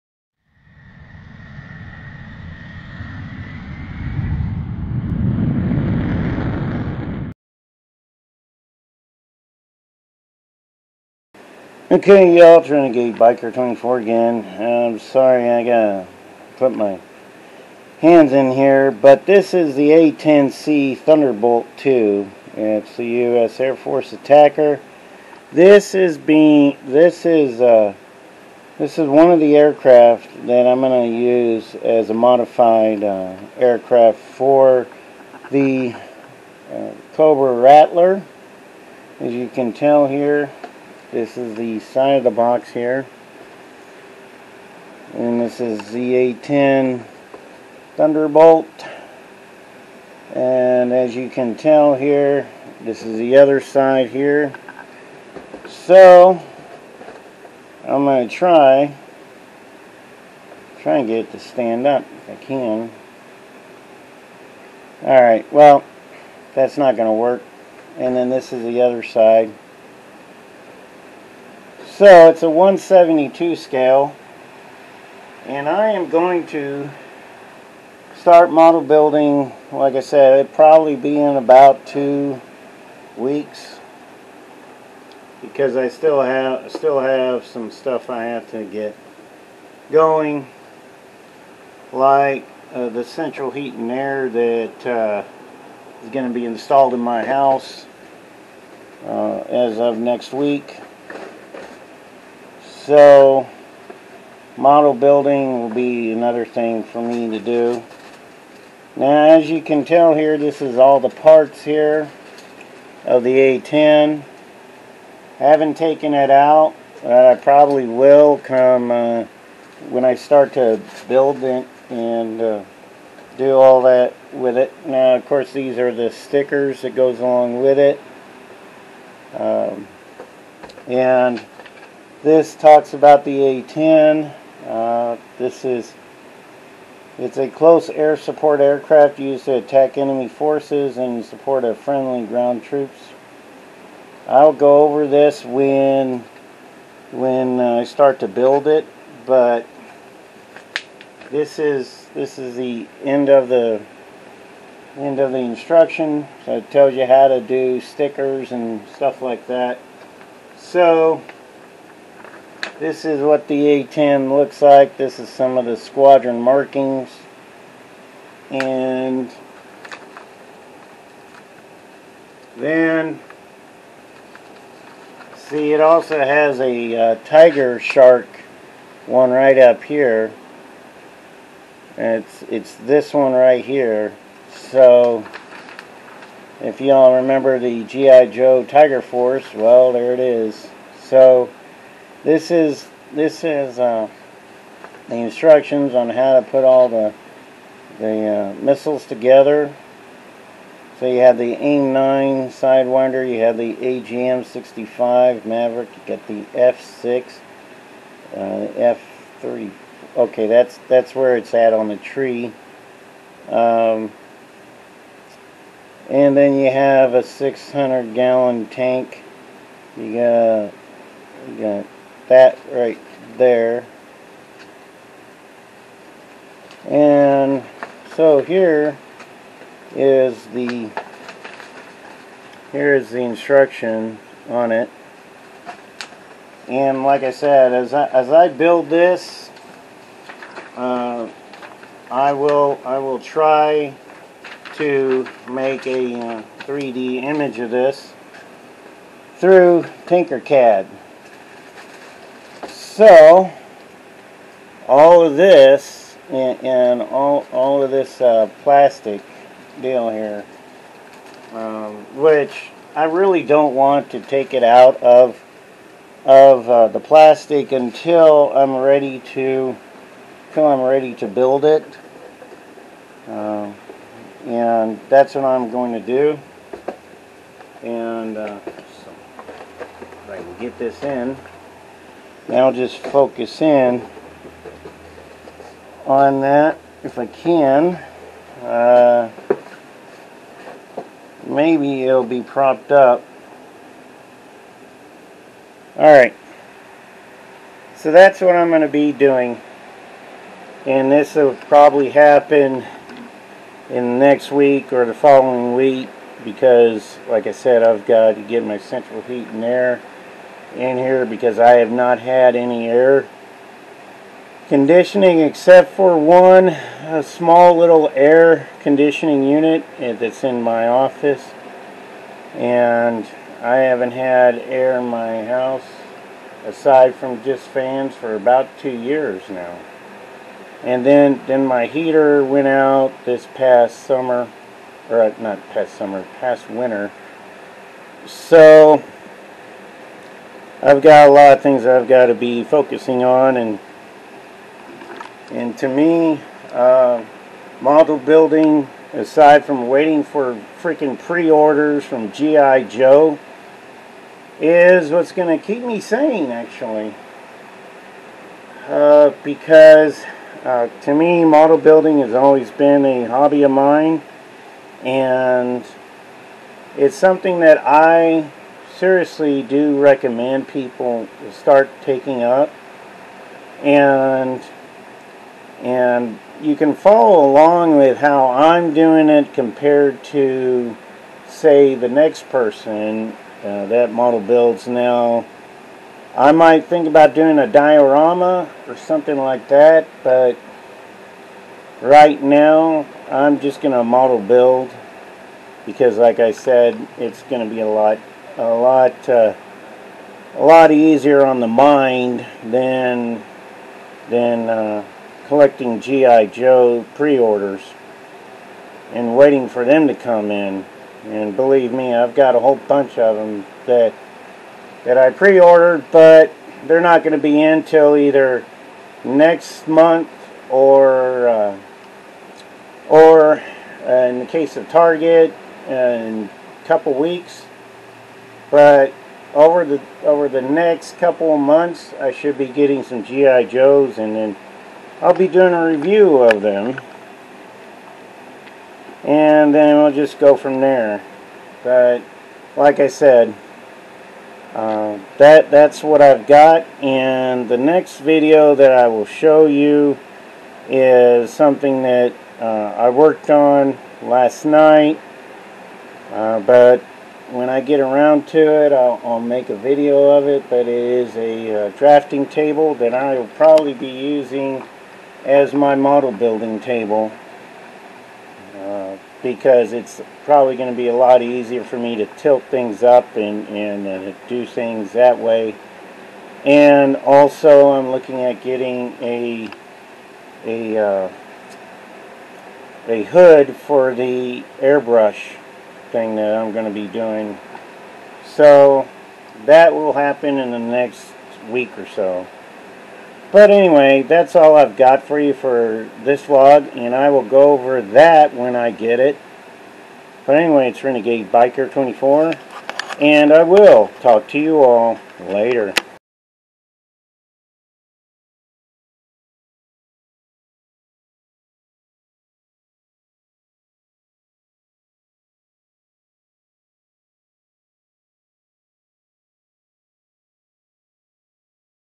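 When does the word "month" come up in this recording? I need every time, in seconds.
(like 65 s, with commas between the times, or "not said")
419 s, 431 s.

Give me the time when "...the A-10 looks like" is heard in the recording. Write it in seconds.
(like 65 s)
163 s.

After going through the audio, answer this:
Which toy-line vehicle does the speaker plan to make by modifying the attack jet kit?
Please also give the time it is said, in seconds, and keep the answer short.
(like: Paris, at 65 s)
Cobra Rattler, at 37 s.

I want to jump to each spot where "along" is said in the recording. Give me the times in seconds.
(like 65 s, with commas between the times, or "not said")
127 s, 377 s.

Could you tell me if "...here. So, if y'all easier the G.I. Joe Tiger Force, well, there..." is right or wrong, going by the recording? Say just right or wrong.
wrong.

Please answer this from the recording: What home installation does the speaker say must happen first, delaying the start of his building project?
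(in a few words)
central heat and air.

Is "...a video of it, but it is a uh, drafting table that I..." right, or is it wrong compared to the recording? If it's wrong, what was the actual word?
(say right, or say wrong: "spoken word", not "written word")
right.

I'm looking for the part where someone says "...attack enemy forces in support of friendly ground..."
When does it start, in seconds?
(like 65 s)
139 s.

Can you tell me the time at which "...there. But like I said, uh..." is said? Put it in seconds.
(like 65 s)
440 s.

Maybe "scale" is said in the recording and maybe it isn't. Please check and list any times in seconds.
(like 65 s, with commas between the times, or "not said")
73 s.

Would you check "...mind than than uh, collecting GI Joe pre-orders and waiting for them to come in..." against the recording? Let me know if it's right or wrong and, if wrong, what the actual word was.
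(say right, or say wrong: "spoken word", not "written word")
right.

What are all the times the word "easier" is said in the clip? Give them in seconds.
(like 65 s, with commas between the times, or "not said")
400 s, 471 s.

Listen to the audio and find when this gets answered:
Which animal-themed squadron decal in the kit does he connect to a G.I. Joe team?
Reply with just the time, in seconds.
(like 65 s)
177 s.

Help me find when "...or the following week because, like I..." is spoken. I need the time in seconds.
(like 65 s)
304 s.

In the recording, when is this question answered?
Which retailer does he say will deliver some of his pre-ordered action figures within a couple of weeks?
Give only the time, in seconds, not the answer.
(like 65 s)
424 s.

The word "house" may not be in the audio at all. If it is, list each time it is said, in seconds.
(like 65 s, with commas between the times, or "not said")
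97 s, 325 s.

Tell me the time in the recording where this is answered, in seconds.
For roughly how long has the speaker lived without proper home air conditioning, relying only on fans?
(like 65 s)
328 s.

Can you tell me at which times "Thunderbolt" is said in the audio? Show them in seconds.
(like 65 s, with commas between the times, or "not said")
20 s, 47 s.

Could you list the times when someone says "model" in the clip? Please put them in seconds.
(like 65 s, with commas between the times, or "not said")
78 s, 104 s, 347 s, 361 s, 384 s, 394 s, 465 s.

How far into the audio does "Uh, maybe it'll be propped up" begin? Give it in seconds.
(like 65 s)
288 s.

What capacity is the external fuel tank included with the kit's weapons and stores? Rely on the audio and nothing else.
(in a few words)
600 gallons.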